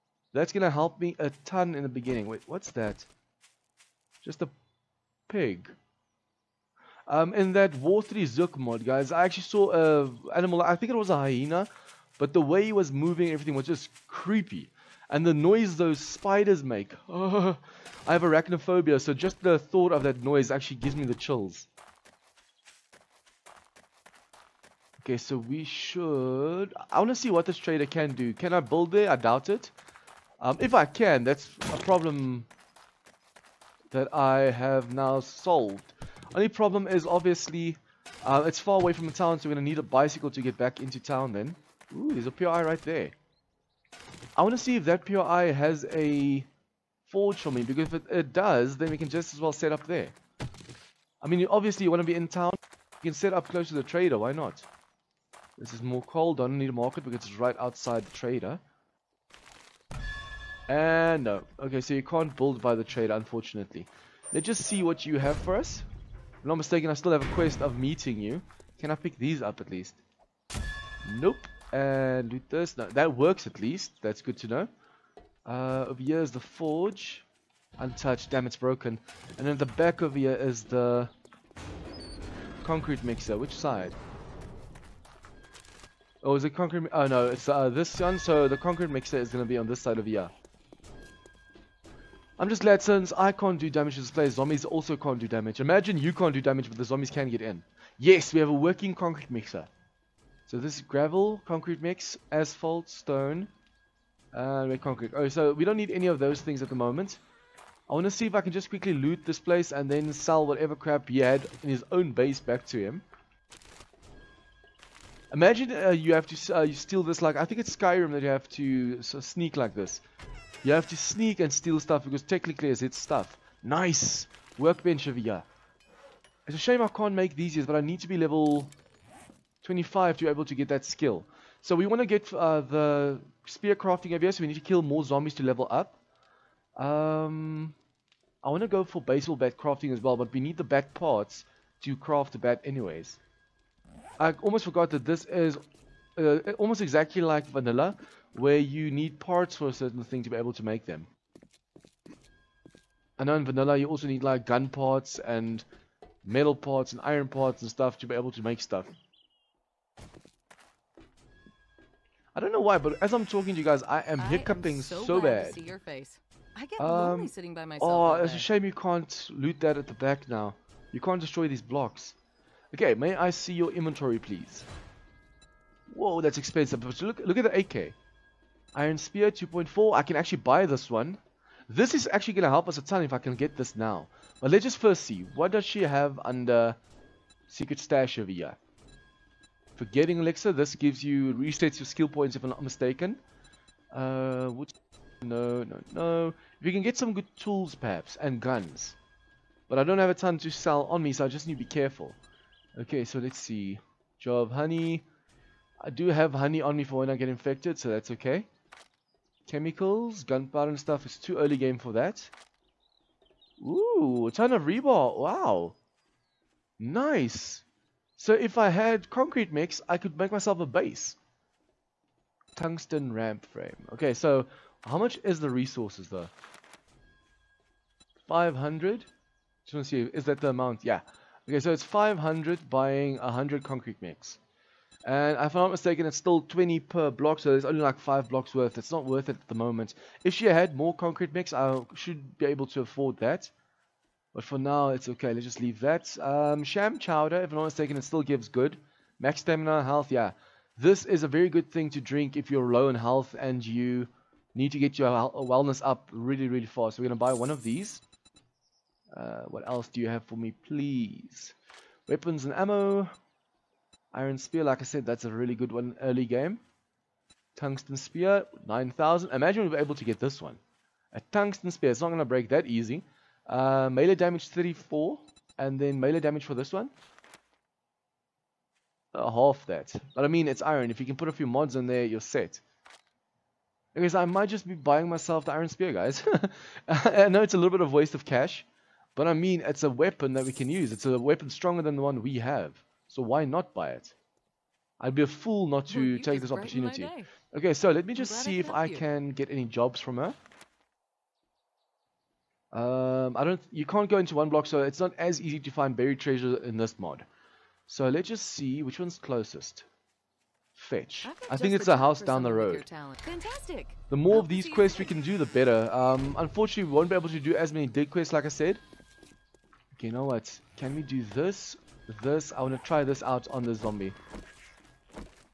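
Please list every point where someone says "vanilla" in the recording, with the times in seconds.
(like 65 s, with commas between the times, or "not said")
147 s, 153 s.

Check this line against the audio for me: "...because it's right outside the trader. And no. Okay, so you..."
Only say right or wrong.
right.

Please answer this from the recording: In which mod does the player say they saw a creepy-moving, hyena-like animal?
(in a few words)
War3zuk.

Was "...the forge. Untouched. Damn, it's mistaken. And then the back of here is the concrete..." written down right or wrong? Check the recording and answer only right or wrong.
wrong.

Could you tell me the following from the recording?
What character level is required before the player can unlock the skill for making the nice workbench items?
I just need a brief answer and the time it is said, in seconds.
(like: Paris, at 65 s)
25, at 128 s.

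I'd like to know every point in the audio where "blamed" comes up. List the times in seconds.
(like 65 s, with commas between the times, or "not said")
not said.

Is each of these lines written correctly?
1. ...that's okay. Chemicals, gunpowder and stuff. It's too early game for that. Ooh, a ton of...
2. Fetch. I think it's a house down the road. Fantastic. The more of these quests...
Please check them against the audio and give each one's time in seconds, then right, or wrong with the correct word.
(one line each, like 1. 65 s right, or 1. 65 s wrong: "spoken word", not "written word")
1. 207 s right
2. 310 s right.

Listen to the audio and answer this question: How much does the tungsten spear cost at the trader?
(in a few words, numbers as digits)
9,000.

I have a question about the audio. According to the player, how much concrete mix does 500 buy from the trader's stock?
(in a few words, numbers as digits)
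100.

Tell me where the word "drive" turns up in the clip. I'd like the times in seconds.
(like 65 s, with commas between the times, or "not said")
not said.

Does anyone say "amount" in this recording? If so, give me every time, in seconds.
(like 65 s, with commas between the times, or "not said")
230 s.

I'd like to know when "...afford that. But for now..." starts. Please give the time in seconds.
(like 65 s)
242 s.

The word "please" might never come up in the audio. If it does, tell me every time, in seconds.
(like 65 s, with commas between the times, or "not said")
174 s, 260 s.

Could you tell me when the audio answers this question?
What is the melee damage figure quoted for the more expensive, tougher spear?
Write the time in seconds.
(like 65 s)
274 s.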